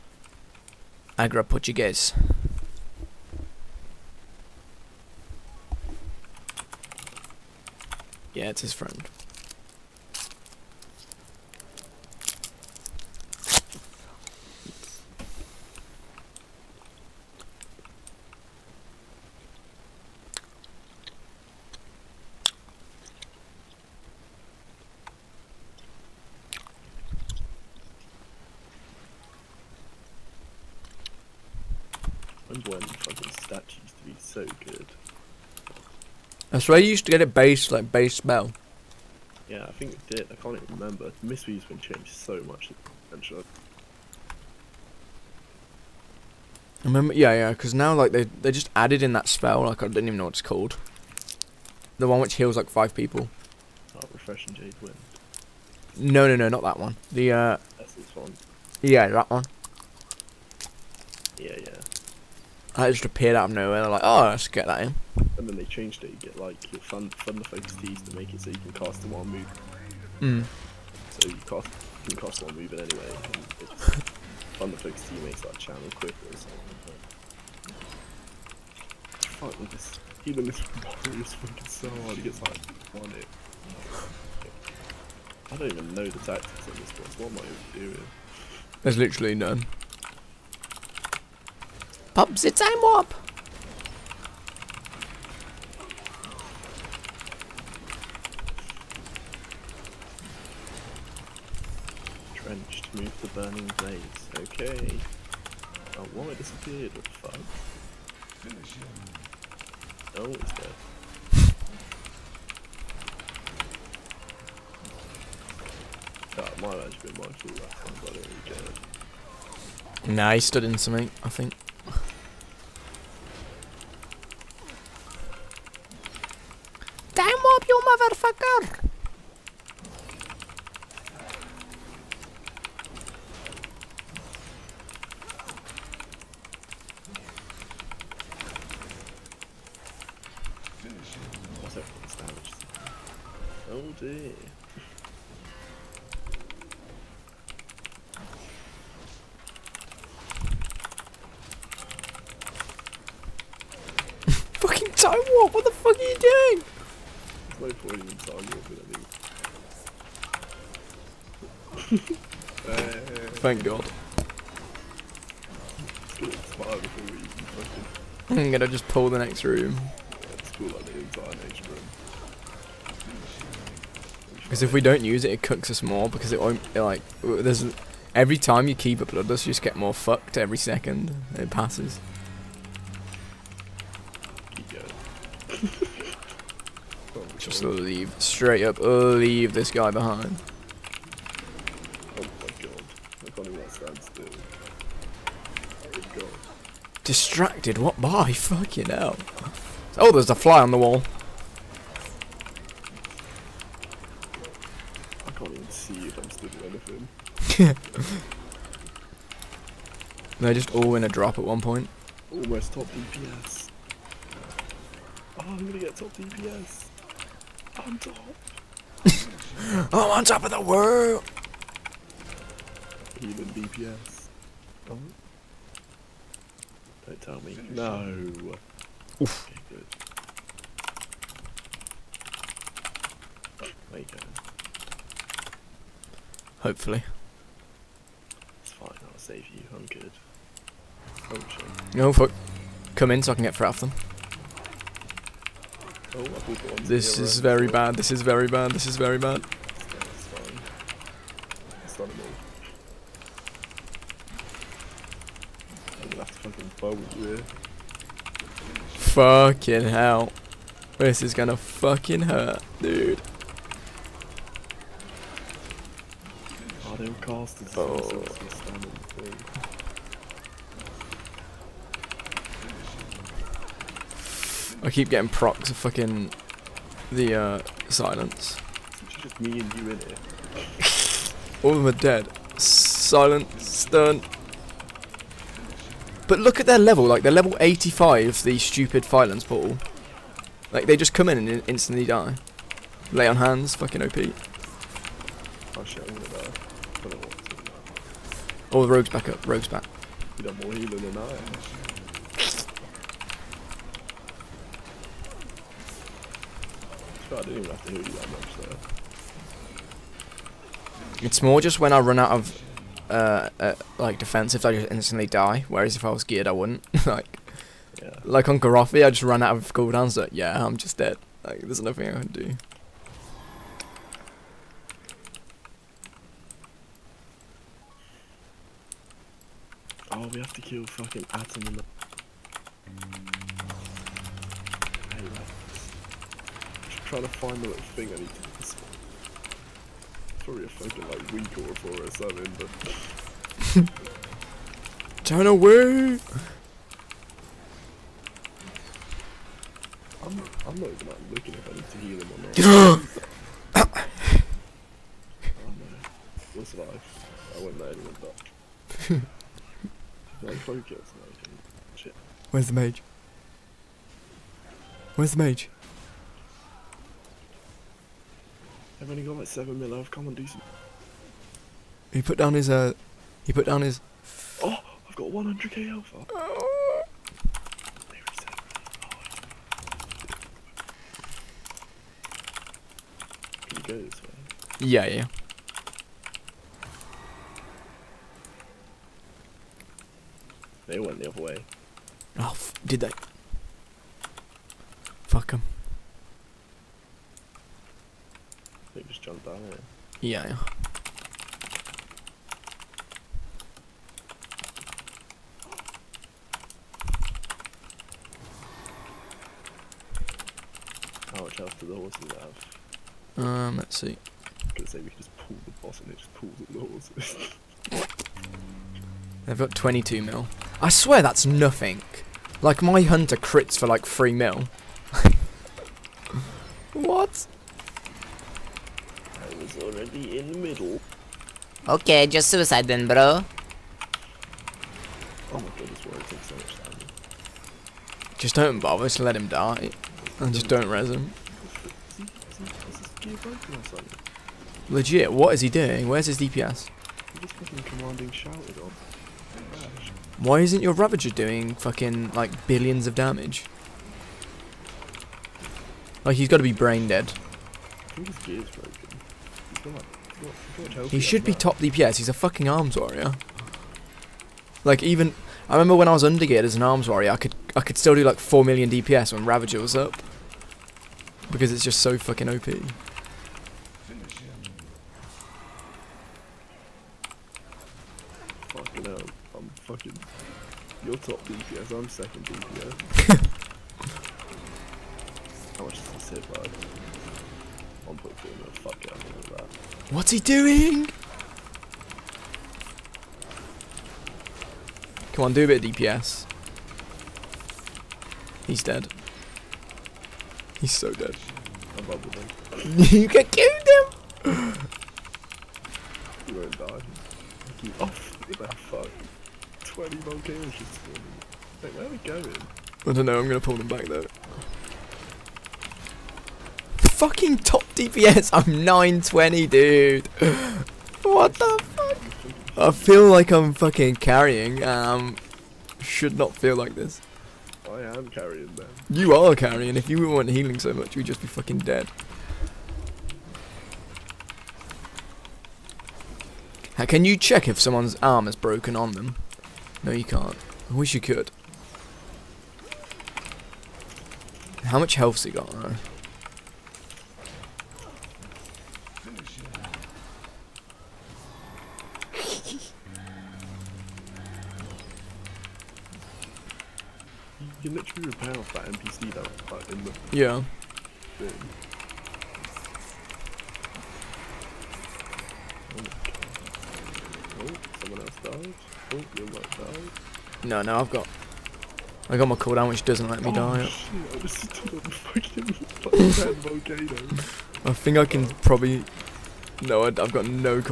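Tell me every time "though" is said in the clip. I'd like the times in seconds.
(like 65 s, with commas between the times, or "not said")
514 s, 545 s.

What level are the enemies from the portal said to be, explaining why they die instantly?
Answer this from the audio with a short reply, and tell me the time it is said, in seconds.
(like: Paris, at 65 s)
85, at 287 s.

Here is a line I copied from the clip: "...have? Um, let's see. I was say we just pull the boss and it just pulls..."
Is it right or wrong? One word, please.
right.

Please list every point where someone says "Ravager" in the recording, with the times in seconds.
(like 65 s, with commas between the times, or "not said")
450 s, 469 s.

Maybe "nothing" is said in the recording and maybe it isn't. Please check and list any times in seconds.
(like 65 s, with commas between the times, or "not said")
321 s, 421 s.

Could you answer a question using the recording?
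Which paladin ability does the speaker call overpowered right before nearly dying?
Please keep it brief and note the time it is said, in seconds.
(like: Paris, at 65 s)
Lay on Hands, at 293 s.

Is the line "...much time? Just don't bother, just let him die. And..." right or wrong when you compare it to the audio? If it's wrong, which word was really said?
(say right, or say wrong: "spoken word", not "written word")
right.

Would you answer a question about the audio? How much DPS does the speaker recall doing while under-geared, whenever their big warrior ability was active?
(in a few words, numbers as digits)
4 million.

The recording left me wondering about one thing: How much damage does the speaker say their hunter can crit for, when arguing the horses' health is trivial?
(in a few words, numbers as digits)
3 million.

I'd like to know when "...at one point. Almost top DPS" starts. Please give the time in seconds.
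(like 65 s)
211 s.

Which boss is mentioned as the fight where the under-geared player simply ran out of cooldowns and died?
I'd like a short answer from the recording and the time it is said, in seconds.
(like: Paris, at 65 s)
Garothi, at 318 s.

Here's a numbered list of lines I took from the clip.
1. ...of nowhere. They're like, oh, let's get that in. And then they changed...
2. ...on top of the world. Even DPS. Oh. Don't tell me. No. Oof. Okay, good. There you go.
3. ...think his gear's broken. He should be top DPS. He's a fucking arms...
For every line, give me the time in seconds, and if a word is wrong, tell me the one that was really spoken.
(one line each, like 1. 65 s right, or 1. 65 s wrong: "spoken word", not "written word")
1. 63 s right
2. 220 s right
3. 458 s right.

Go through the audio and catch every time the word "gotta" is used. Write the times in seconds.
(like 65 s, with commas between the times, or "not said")
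456 s.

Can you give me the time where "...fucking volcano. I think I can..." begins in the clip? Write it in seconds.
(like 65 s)
575 s.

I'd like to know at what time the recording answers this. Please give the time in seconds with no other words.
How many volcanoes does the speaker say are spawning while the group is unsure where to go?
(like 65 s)
509 s.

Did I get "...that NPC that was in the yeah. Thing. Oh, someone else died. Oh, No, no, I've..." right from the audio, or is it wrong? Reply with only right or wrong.
right.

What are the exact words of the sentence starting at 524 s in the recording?
Um, should not feel like this.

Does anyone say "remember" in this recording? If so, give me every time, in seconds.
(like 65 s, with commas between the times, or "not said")
40 s, 46 s, 465 s.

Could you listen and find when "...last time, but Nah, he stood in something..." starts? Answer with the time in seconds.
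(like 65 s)
117 s.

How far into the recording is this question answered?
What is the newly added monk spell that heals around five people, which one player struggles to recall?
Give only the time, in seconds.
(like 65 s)
54 s.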